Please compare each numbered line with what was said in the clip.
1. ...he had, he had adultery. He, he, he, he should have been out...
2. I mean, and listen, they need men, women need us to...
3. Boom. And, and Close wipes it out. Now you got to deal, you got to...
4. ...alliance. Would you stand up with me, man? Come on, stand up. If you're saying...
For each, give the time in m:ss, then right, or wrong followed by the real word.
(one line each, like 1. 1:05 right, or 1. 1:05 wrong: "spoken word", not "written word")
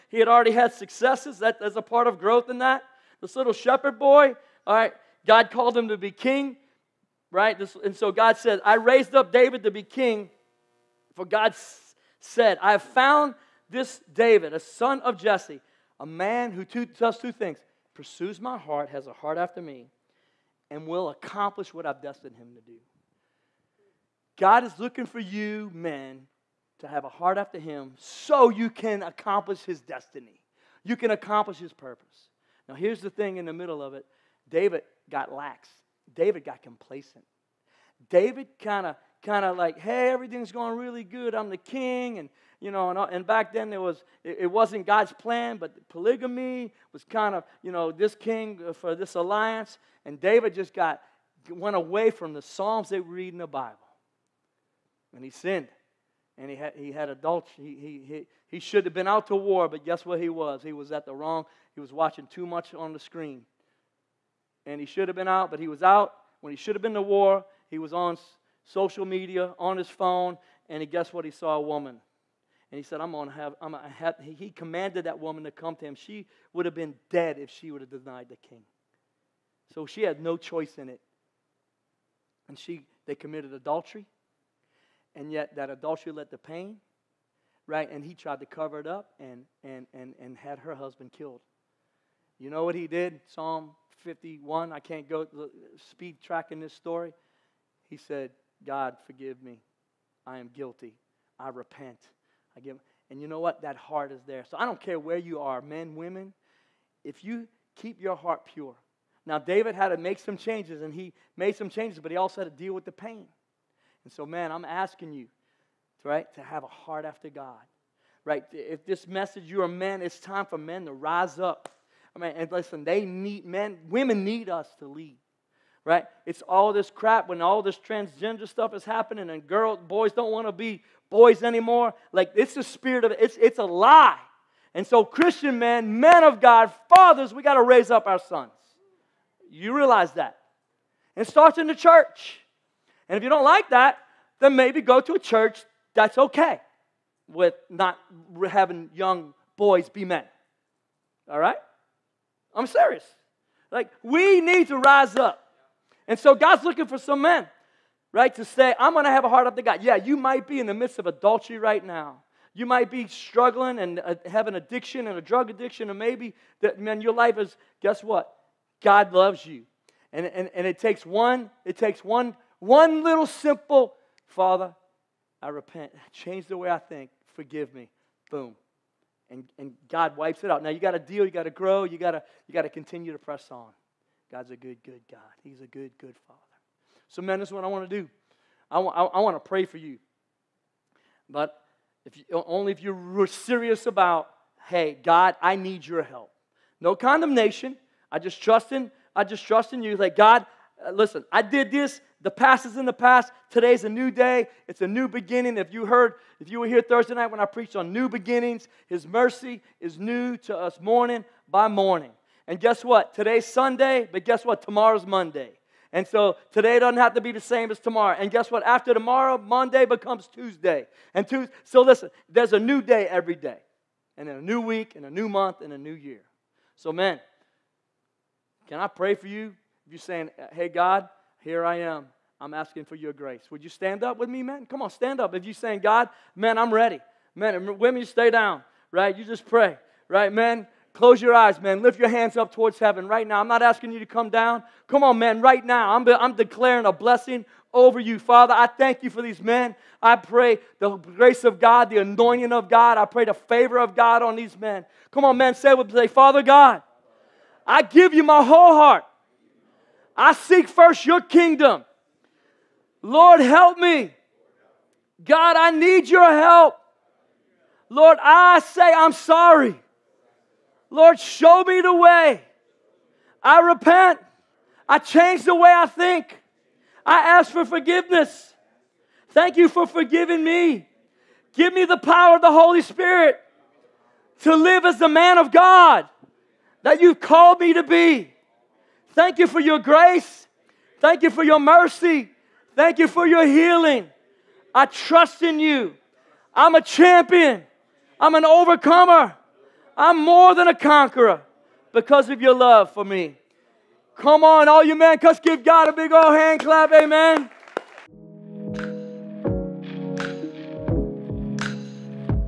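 1. 0:56 right
2. 2:02 right
3. 2:58 wrong: "God", not "Close"
4. 3:53 wrong: "grace", not "alliance".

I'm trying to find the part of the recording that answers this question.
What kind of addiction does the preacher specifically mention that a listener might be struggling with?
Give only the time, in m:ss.
2:45.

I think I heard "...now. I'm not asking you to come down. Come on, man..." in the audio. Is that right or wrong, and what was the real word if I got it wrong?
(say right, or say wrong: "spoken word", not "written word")
right.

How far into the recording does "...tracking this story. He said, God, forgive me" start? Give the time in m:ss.
1:36.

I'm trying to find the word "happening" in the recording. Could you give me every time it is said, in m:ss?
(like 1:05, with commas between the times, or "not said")
2:08.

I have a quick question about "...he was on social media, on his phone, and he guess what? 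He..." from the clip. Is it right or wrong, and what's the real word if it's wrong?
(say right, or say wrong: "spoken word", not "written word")
right.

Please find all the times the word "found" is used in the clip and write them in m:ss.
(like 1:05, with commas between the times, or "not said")
0:12.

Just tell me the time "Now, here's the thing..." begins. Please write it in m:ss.
0:32.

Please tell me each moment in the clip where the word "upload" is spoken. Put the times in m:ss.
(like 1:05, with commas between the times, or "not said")
not said.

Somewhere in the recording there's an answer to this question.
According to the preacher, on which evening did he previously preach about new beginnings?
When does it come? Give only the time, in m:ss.
3:26.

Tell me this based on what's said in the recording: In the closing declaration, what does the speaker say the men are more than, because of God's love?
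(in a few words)
a conqueror.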